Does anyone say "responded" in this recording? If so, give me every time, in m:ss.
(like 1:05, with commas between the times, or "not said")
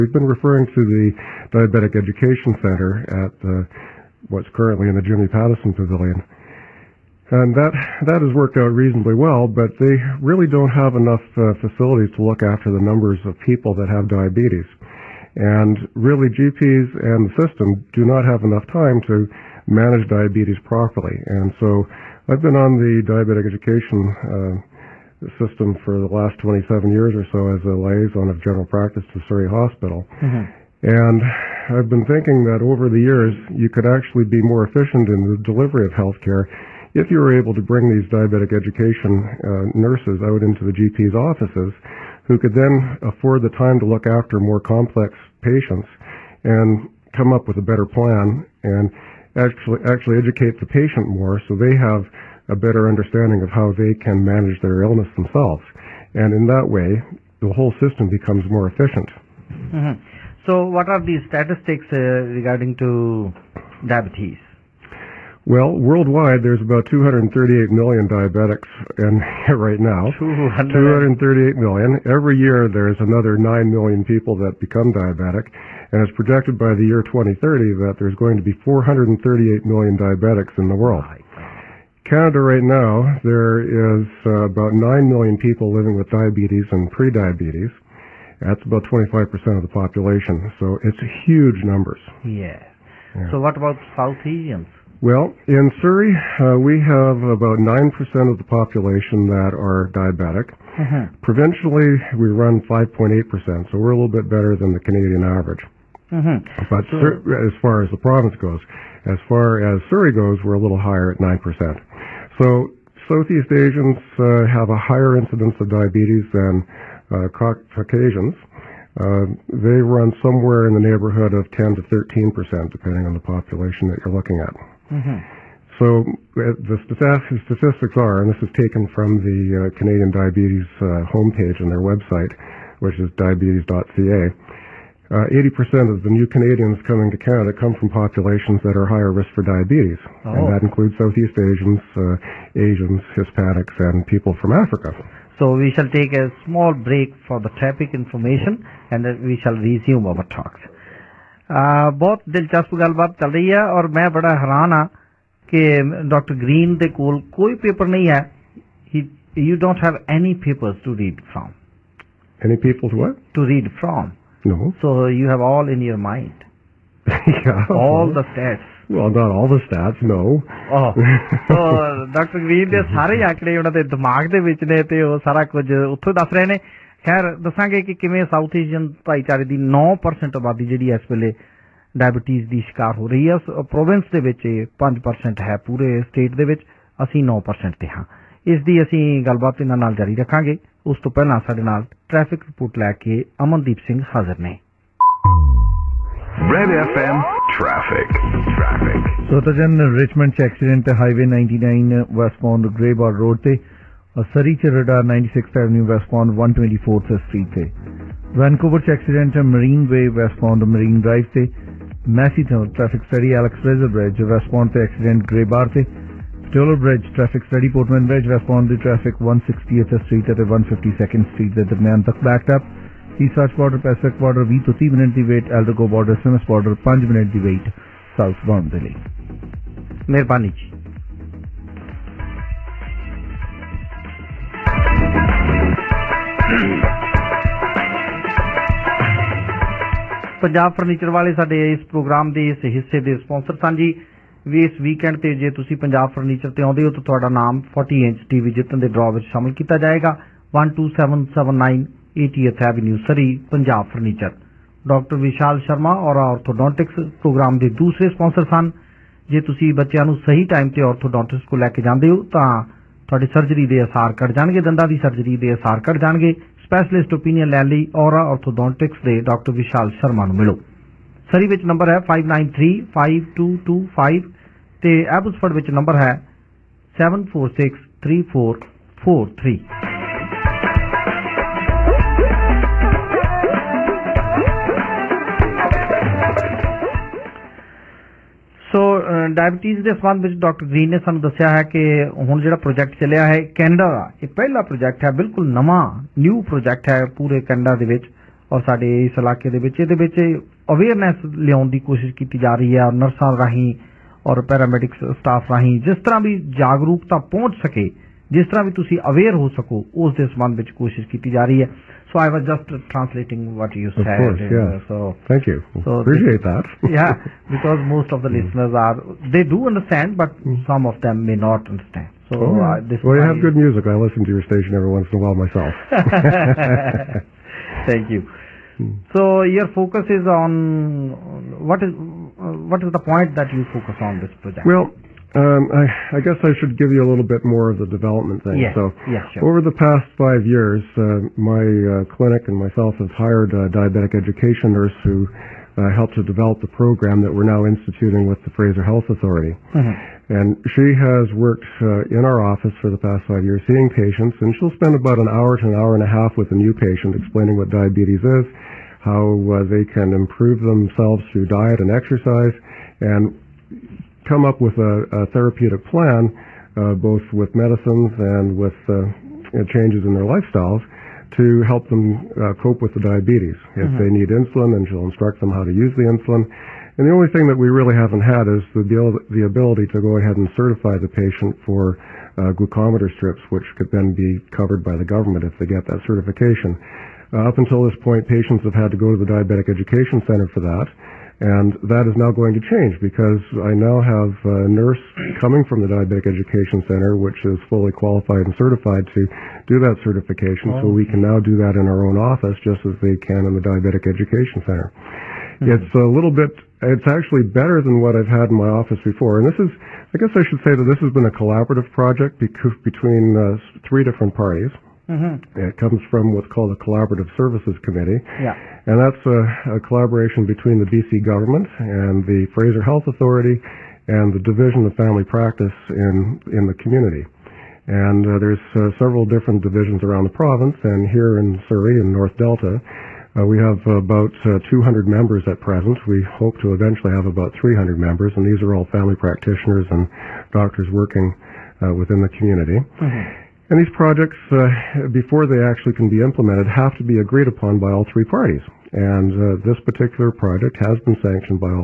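3:38.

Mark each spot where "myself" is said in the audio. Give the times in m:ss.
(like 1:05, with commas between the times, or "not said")
5:25, 5:42.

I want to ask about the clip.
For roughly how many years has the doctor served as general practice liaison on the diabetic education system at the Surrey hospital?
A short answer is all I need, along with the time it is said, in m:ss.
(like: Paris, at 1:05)
27, at 0:26.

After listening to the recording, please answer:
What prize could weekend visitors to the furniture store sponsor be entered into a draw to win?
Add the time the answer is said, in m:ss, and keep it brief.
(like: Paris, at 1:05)
40-inch TV, at 4:07.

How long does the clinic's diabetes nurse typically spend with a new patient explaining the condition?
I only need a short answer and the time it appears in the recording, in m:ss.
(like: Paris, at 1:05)
1 to 1.5 hours, at 5:55.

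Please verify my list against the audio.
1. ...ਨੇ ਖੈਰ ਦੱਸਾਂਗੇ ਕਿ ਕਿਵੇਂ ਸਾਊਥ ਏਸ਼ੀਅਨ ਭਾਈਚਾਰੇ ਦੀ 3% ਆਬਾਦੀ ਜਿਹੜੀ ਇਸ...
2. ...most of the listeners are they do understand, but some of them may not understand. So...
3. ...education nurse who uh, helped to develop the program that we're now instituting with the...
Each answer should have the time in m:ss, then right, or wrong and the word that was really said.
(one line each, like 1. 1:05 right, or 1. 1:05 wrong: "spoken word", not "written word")
1. 2:56 wrong: "9", not "3"
2. 5:17 right
3. 5:44 right.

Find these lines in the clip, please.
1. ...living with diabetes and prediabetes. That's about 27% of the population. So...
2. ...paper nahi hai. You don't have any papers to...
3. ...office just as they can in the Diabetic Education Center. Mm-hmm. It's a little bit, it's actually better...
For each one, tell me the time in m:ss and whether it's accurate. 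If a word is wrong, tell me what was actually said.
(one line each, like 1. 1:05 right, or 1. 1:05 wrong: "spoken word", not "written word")
1. 1:25 wrong: "25", not "27"
2. 2:37 right
3. 6:42 right.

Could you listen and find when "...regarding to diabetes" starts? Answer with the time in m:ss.
1:02.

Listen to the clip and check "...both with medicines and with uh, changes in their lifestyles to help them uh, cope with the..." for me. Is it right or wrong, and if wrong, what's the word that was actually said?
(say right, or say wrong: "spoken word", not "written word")
right.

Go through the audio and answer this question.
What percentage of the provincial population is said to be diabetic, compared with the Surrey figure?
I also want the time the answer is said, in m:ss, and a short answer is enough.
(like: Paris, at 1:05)
5.8%, at 1:42.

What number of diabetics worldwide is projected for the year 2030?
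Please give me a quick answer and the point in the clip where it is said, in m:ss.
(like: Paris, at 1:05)
438 million, at 1:18.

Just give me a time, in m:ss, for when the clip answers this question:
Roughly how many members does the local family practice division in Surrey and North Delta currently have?
7:14.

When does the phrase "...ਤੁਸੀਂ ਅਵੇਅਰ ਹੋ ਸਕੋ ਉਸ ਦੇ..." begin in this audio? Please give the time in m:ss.
5:08.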